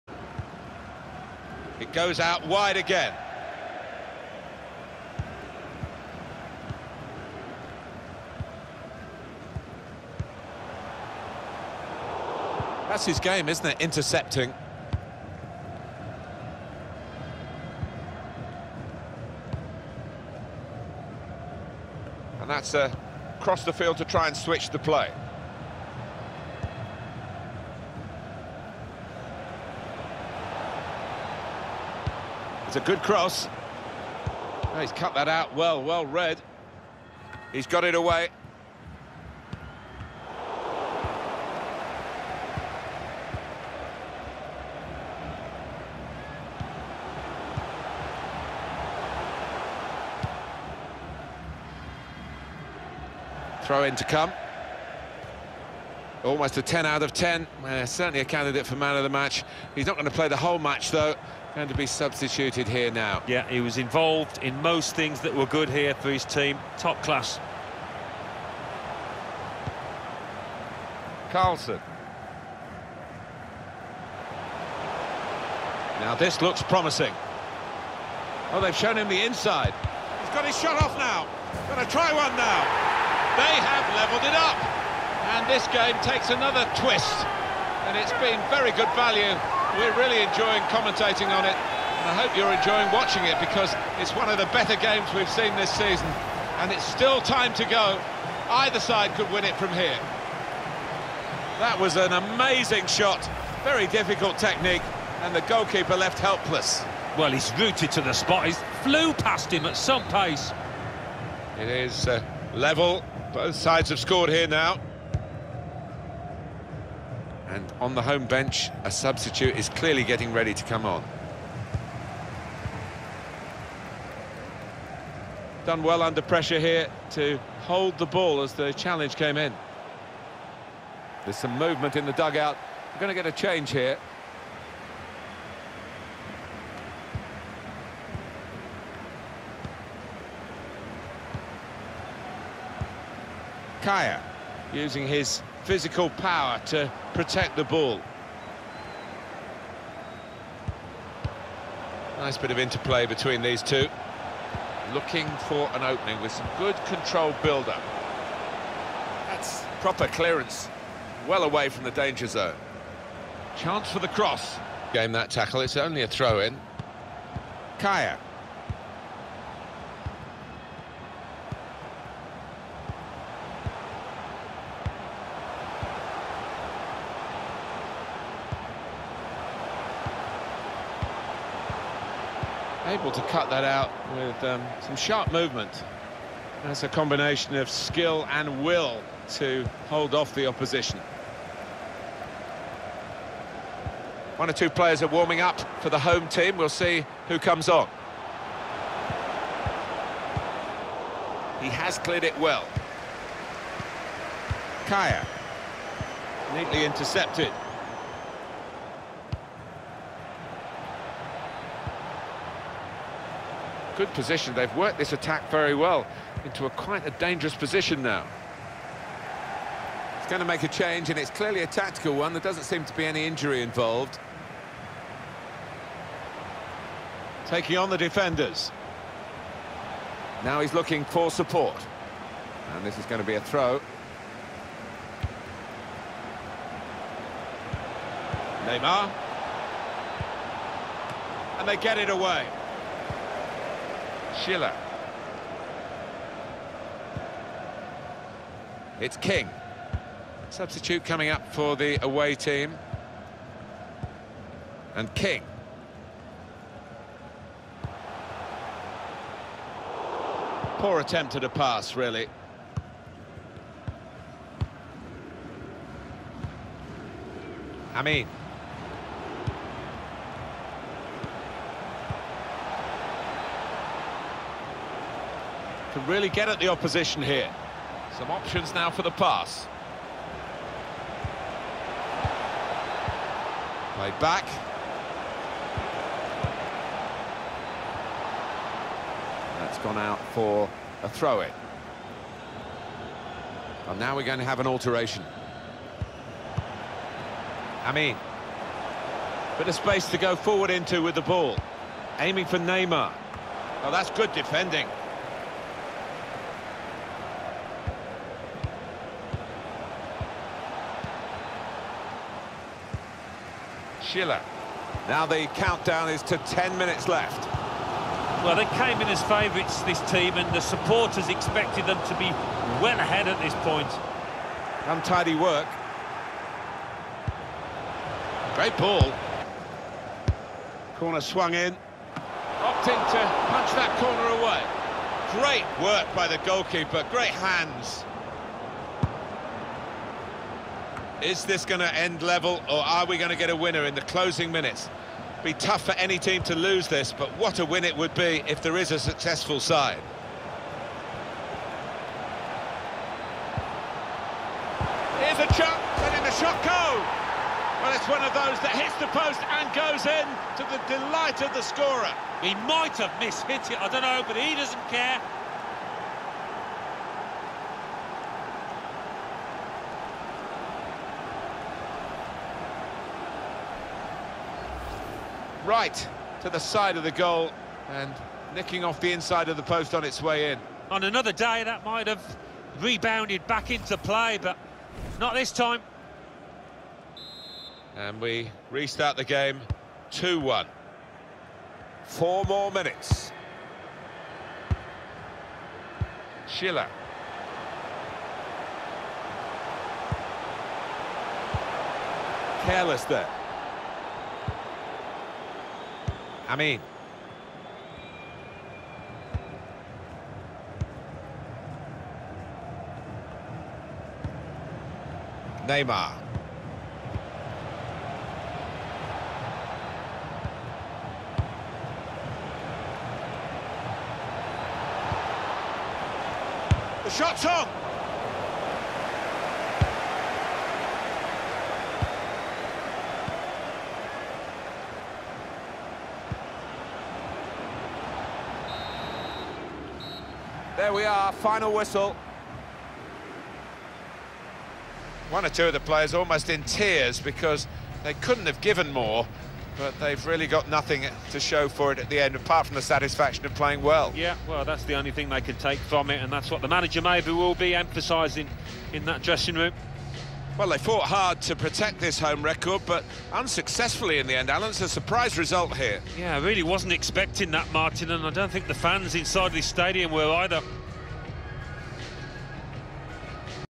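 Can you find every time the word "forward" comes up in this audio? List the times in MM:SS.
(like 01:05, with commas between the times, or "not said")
05:00.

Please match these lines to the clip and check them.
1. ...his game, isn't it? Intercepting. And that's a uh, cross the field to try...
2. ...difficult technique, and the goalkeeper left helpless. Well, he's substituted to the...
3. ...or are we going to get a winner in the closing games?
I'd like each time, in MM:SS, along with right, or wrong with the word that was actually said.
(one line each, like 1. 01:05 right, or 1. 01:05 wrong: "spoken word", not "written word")
1. 00:13 right
2. 01:43 wrong: "rooted", not "substituted"
3. 05:42 wrong: "minutes", not "games".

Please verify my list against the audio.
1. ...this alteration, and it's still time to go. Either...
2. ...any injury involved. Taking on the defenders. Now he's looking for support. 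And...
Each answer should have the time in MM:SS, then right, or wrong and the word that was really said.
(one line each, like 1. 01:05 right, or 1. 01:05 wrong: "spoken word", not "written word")
1. 01:35 wrong: "season", not "alteration"
2. 03:43 right.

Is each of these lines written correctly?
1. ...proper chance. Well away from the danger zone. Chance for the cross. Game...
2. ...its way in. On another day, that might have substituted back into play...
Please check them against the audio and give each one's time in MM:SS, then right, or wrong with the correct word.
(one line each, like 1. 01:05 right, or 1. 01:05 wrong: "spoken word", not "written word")
1. 02:39 wrong: "clearance", not "chance"
2. 06:20 wrong: "rebounded", not "substituted".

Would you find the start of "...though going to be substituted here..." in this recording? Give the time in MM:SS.
01:00.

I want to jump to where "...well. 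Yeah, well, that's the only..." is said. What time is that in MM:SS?
07:33.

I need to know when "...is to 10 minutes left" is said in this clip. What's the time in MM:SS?
05:16.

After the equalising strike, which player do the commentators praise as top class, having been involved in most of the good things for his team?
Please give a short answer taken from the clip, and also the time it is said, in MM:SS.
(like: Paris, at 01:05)
Carlson, at 01:11.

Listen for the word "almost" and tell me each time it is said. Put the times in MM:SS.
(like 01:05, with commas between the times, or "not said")
00:56, 07:26.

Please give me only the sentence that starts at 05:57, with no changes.
Well, it's one of those that hits the post and goes in to the delight of the scorer.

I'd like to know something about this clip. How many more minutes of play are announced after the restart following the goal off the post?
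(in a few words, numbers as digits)
4.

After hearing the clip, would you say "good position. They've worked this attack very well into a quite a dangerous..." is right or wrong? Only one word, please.
right.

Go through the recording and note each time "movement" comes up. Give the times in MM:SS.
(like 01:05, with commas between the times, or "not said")
02:11, 03:05.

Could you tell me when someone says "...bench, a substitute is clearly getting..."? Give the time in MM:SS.
01:58.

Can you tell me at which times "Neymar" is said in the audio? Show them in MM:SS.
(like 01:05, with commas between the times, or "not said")
03:58, 05:02, 06:55.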